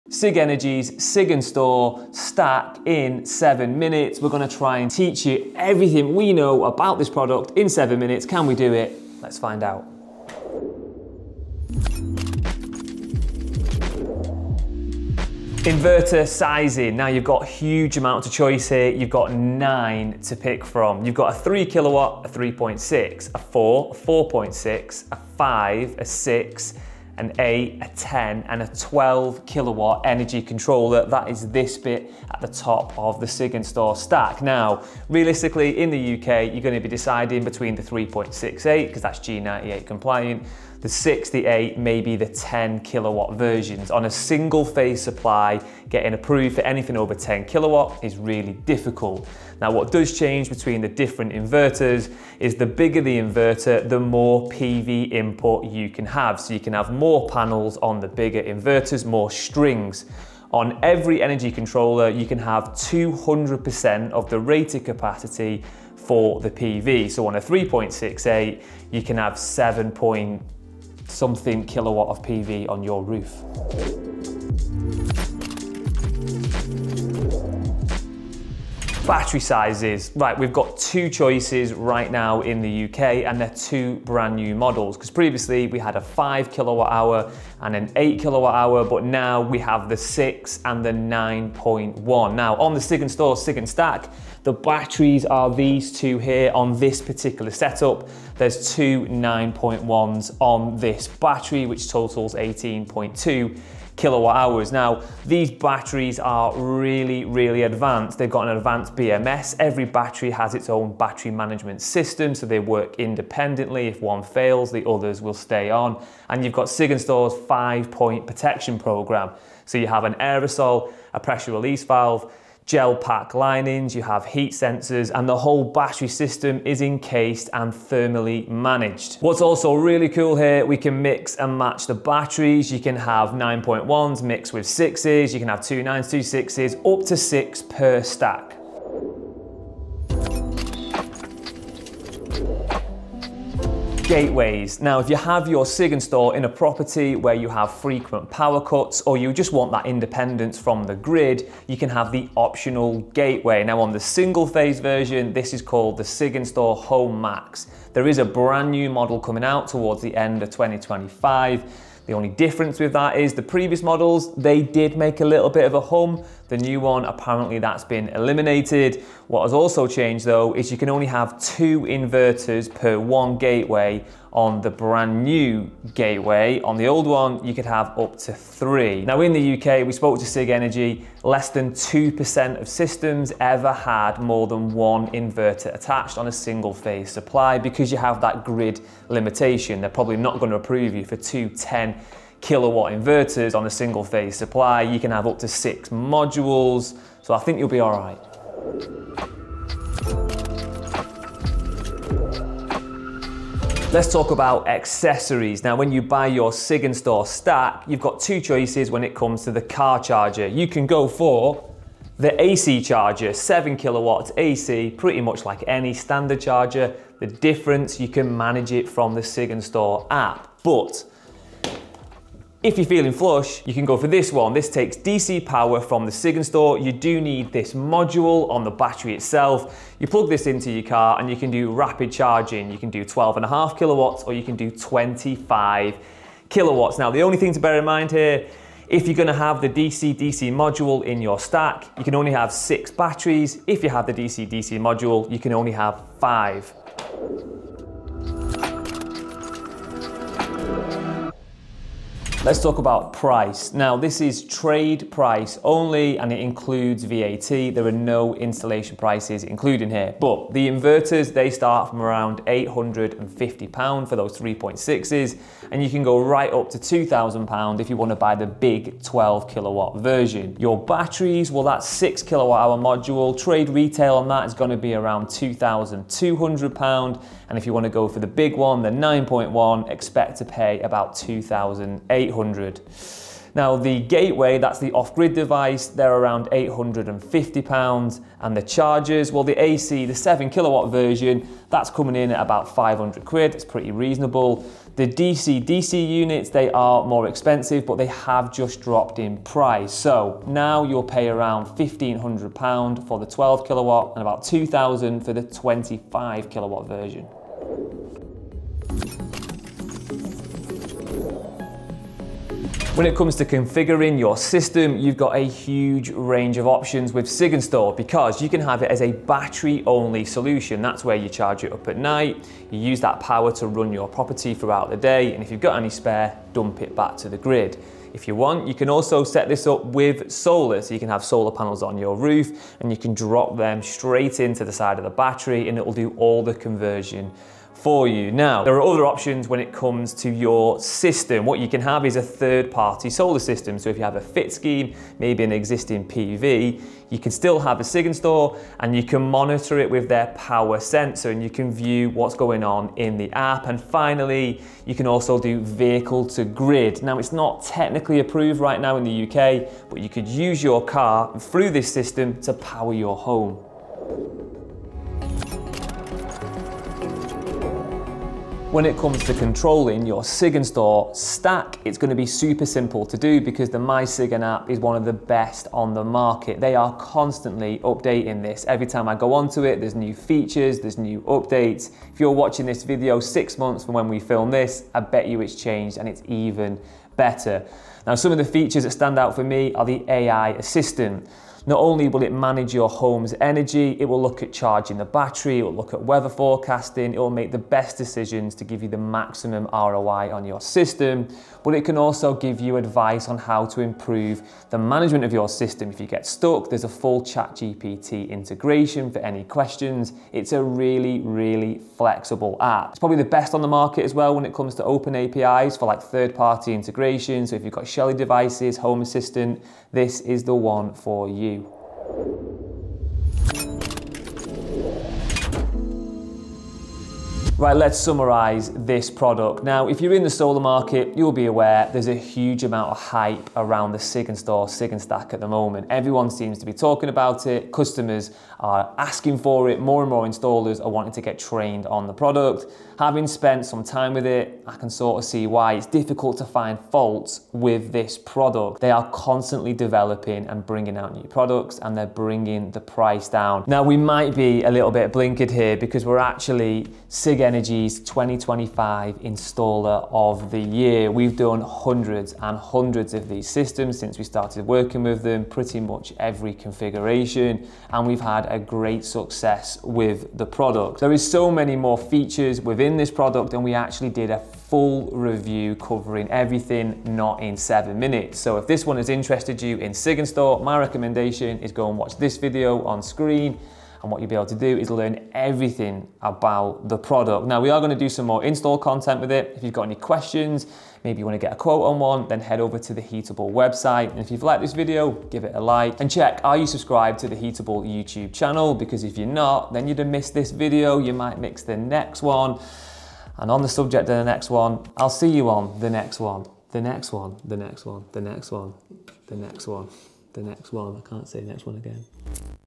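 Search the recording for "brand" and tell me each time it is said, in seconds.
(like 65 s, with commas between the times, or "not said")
84 s, 158 s, 174 s.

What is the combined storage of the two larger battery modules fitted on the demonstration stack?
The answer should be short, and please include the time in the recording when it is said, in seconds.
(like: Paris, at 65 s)
18.2 kilowatt hours, at 102 s.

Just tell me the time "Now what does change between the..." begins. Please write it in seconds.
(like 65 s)
49 s.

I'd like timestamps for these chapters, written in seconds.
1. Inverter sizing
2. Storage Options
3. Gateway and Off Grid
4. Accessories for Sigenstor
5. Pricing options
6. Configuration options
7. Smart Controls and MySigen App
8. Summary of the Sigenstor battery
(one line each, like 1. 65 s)
1. 14 s
2. 76 s
3. 141 s
4. 200 s
5. 248 s
6. 309 s
7. 365 s
8. 427 s.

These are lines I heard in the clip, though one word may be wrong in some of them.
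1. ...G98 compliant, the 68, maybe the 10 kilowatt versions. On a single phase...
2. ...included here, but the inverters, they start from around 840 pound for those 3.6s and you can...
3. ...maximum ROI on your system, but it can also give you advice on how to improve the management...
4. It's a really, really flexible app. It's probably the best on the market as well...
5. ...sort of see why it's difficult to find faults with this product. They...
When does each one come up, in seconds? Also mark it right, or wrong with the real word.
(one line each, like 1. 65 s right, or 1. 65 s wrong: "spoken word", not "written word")
1. 39 s right
2. 259 s wrong: "850", not "840"
3. 398 s right
4. 410 s right
5. 444 s right.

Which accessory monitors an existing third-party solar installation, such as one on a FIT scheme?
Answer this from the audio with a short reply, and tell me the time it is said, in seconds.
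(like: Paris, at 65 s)
power sensor, at 350 s.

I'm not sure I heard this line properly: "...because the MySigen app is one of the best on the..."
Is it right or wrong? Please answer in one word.
right.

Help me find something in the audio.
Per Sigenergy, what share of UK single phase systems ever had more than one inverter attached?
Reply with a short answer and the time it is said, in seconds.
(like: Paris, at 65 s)
less than 2%, at 181 s.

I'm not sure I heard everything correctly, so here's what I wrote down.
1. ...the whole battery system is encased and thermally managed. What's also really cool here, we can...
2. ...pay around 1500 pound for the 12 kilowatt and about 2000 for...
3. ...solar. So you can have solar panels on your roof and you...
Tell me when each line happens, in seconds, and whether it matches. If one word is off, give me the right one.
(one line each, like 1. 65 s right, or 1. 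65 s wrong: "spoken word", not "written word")
1. 125 s right
2. 301 s right
3. 330 s right.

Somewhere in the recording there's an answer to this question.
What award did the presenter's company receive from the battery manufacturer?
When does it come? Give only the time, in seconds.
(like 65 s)
457 s.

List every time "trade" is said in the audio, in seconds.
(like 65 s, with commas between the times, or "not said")
254 s, 273 s.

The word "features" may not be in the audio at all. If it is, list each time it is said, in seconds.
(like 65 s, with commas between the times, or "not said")
380 s, 388 s, 471 s.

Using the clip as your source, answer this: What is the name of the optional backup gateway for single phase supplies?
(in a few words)
SIG install Home Max.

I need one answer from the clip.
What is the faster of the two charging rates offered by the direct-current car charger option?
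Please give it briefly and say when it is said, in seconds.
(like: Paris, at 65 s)
25 kilowatts, at 234 s.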